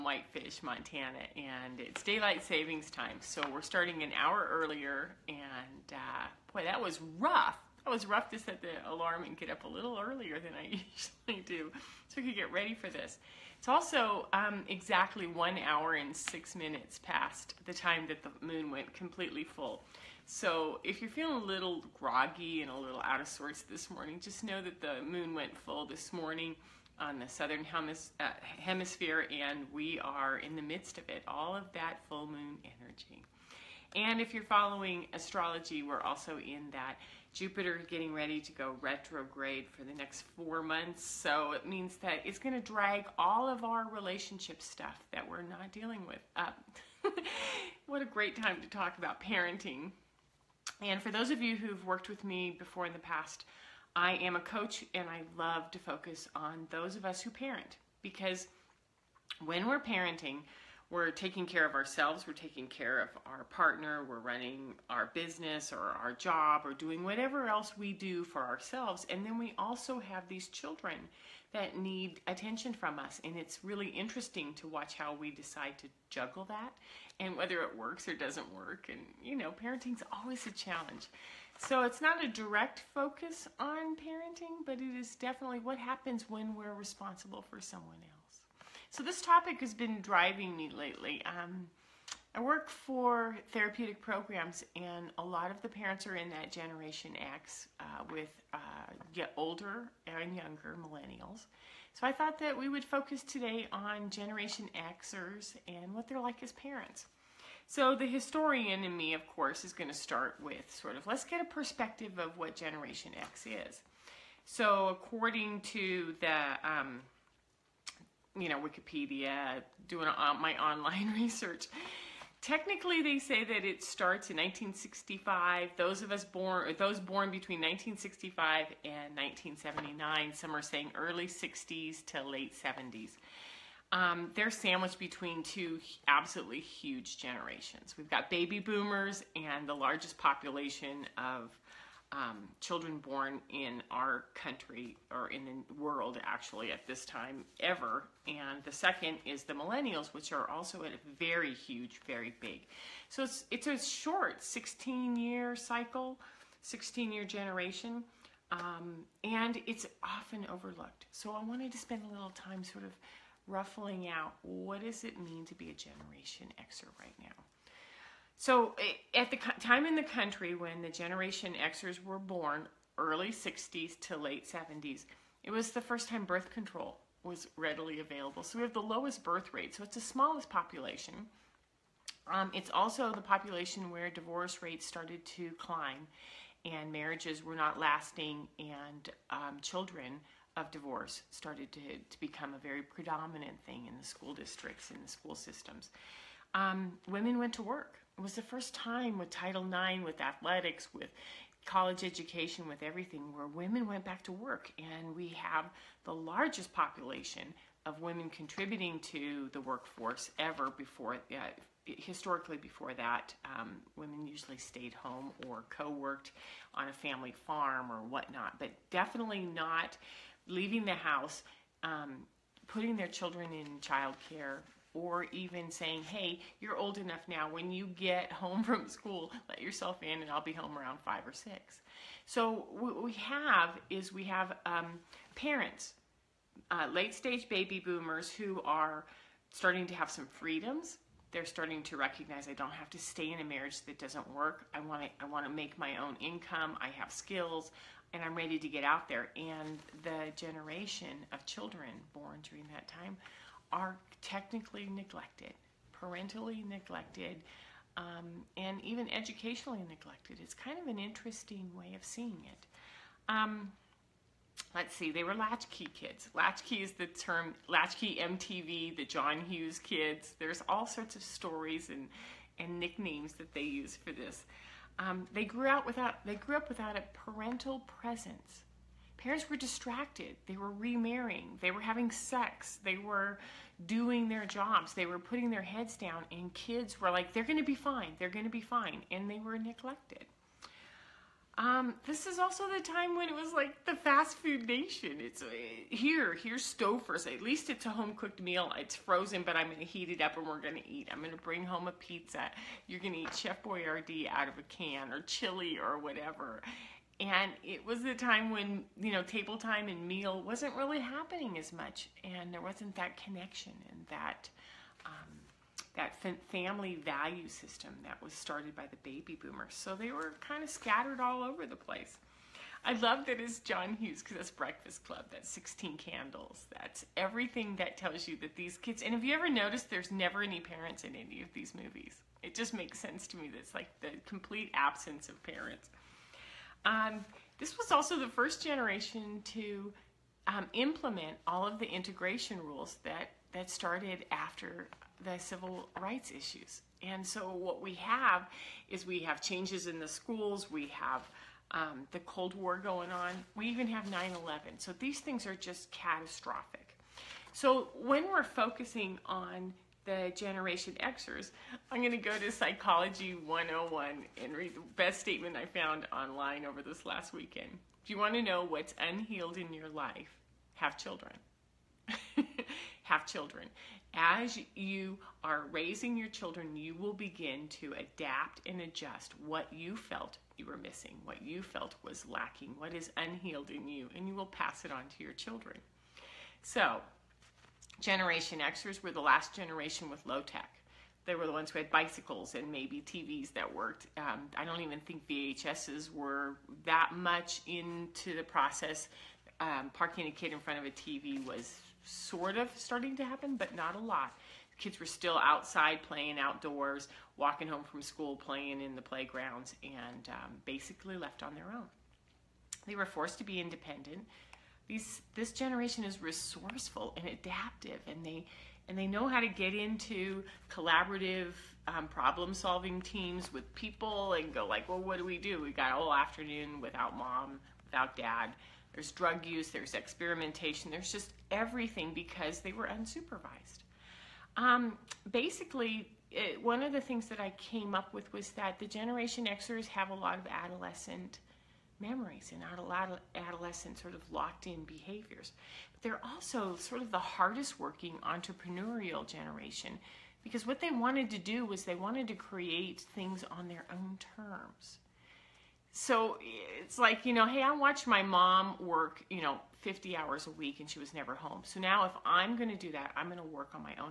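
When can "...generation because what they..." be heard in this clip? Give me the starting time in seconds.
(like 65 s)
449 s.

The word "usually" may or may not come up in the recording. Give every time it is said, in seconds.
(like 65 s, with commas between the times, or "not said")
10 s, 214 s.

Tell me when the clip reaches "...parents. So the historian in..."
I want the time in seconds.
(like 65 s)
106 s.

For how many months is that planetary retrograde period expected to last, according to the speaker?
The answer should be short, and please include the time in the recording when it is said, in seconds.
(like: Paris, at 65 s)
4, at 40 s.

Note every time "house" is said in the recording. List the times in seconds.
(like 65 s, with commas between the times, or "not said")
220 s.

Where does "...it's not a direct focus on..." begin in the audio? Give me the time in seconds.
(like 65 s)
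81 s.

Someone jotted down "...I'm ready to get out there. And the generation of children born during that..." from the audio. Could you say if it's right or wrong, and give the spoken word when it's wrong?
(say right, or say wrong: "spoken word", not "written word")
right.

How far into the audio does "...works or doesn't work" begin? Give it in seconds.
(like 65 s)
77 s.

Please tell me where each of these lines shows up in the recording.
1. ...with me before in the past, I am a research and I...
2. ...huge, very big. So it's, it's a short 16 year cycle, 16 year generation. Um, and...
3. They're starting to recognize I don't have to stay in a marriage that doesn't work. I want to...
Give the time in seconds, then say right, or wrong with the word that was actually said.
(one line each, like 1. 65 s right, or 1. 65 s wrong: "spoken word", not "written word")
1. 52 s wrong: "coach", not "research"
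2. 151 s right
3. 241 s right.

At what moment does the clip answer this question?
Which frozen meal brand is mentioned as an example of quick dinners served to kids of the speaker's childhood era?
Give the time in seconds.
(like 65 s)
296 s.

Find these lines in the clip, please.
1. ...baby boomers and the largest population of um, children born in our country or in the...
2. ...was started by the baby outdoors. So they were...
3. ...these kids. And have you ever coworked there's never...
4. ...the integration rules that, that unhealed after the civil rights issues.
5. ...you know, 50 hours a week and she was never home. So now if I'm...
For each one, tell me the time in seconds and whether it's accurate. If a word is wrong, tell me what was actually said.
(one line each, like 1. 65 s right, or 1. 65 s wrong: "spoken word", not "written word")
1. 138 s right
2. 318 s wrong: "boomers", not "outdoors"
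3. 328 s wrong: "noticed", not "coworked"
4. 341 s wrong: "started", not "unhealed"
5. 459 s right.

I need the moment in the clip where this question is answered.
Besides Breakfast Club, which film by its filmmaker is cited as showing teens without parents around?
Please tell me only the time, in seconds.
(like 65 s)
325 s.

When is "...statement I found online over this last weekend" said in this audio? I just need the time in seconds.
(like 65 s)
365 s.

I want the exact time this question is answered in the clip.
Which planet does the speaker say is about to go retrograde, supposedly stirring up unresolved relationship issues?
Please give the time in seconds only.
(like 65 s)
37 s.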